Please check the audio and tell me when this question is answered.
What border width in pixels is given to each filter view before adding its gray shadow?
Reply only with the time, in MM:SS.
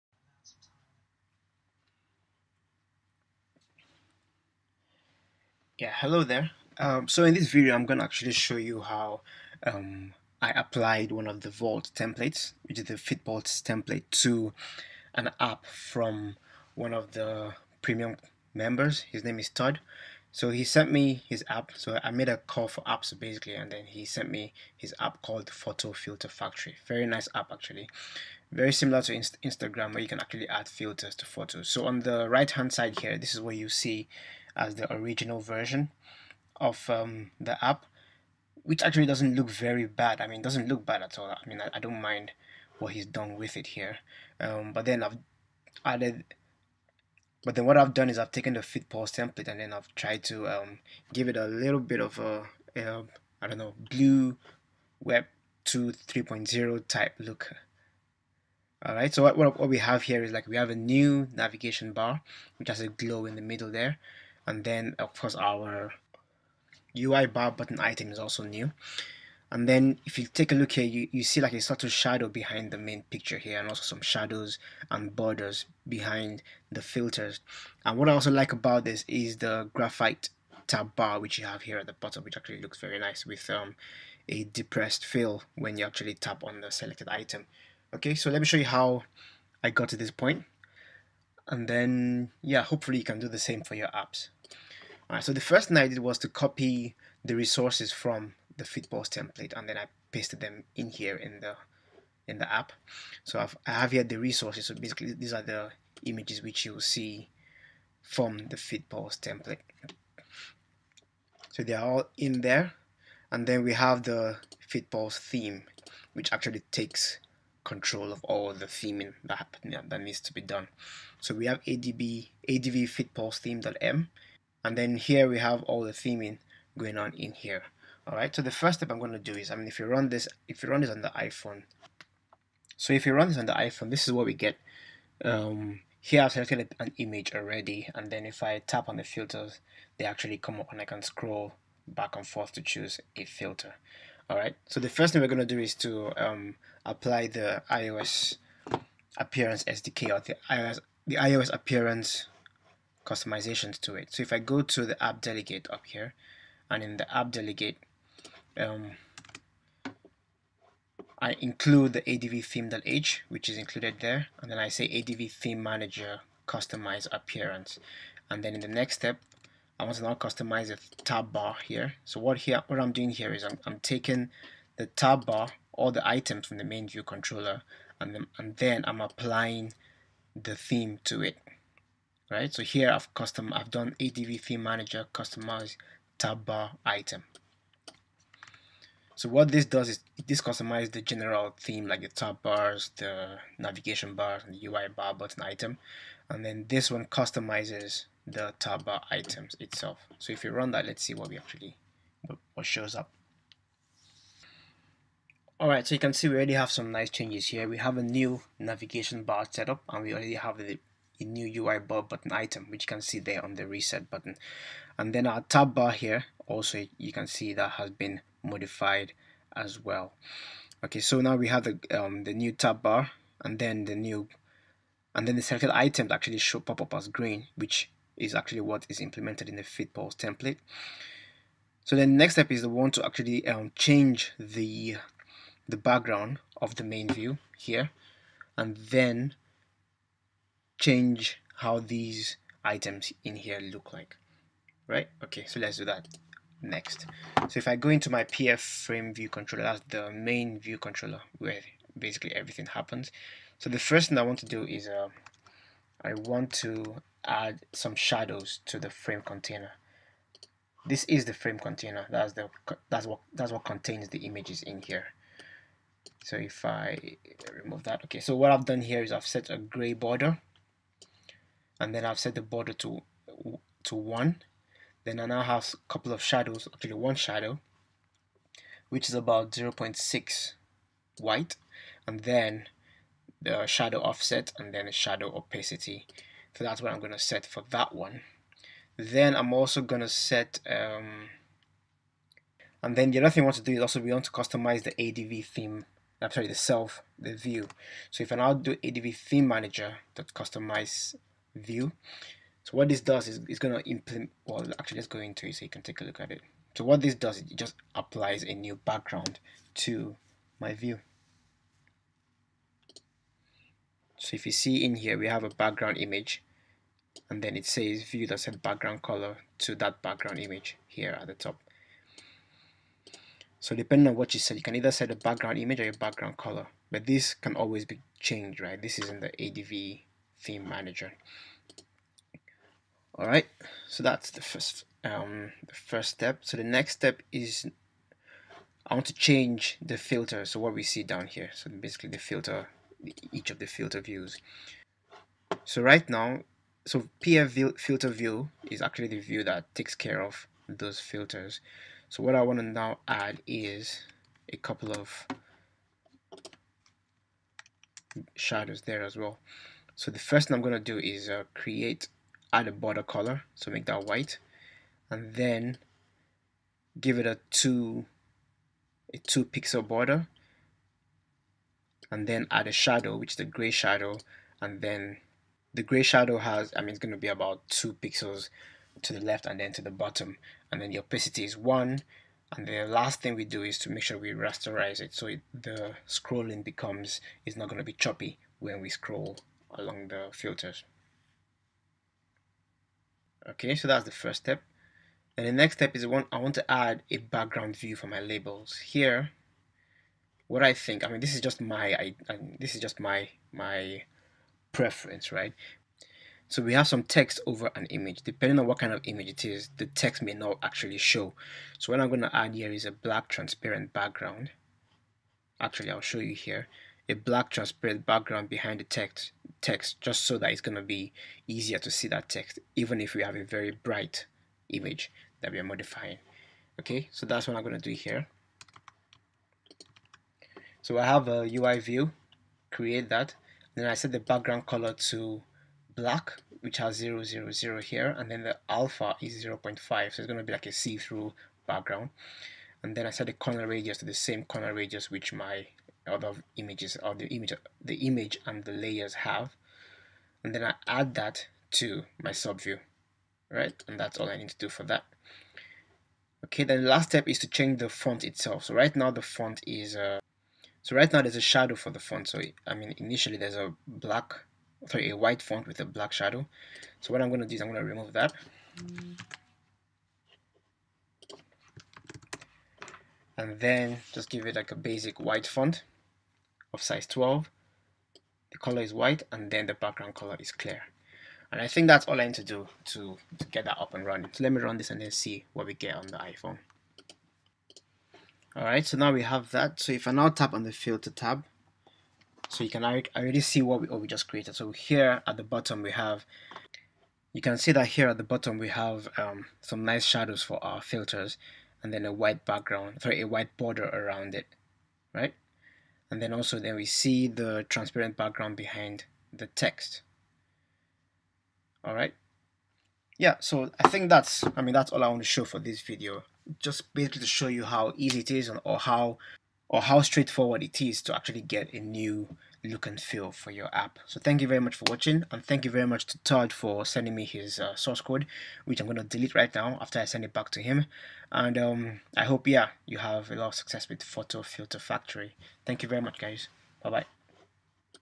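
06:09.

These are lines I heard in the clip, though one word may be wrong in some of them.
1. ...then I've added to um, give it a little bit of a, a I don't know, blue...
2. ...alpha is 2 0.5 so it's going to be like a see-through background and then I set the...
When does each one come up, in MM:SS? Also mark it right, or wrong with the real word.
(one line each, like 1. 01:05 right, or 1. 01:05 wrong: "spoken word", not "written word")
1. 00:49 wrong: "tried", not "added"
2. 07:18 wrong: "0", not "2".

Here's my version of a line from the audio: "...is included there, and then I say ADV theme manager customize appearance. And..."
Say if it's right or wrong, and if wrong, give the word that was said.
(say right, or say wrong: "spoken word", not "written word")
right.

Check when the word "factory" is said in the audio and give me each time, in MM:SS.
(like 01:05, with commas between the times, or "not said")
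00:26, 08:54.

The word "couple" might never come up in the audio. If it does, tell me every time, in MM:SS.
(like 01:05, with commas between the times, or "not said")
04:35, 05:54.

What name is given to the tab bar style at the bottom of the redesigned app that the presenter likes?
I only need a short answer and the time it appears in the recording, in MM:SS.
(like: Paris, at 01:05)
Graphite, at 01:19.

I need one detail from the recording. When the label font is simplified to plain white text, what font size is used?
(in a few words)
12.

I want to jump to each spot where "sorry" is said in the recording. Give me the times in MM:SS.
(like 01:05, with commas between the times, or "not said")
04:56, 07:44, 08:23.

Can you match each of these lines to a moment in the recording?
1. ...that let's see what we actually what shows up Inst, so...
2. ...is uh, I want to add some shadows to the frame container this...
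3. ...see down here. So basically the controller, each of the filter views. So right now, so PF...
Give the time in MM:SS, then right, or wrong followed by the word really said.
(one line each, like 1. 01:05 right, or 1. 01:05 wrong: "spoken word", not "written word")
1. 03:20 wrong: "Alright", not "Inst"
2. 04:14 right
3. 05:40 wrong: "filter", not "controller".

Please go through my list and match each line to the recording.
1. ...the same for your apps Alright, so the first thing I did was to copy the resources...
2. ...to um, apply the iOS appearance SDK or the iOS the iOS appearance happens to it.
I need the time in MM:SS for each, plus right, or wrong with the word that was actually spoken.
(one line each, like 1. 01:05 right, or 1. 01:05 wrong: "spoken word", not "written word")
1. 01:33 right
2. 02:25 wrong: "customizations", not "happens".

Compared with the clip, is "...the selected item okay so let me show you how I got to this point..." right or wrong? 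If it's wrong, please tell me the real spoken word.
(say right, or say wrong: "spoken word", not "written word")
right.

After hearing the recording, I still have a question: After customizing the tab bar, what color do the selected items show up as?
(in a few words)
Green.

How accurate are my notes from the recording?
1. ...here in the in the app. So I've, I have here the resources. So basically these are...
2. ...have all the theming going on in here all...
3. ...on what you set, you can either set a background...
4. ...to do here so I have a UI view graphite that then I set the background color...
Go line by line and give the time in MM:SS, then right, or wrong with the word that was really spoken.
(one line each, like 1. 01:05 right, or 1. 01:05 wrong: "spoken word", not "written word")
1. 01:40 right
2. 02:05 right
3. 05:24 right
4. 07:07 wrong: "create", not "graphite".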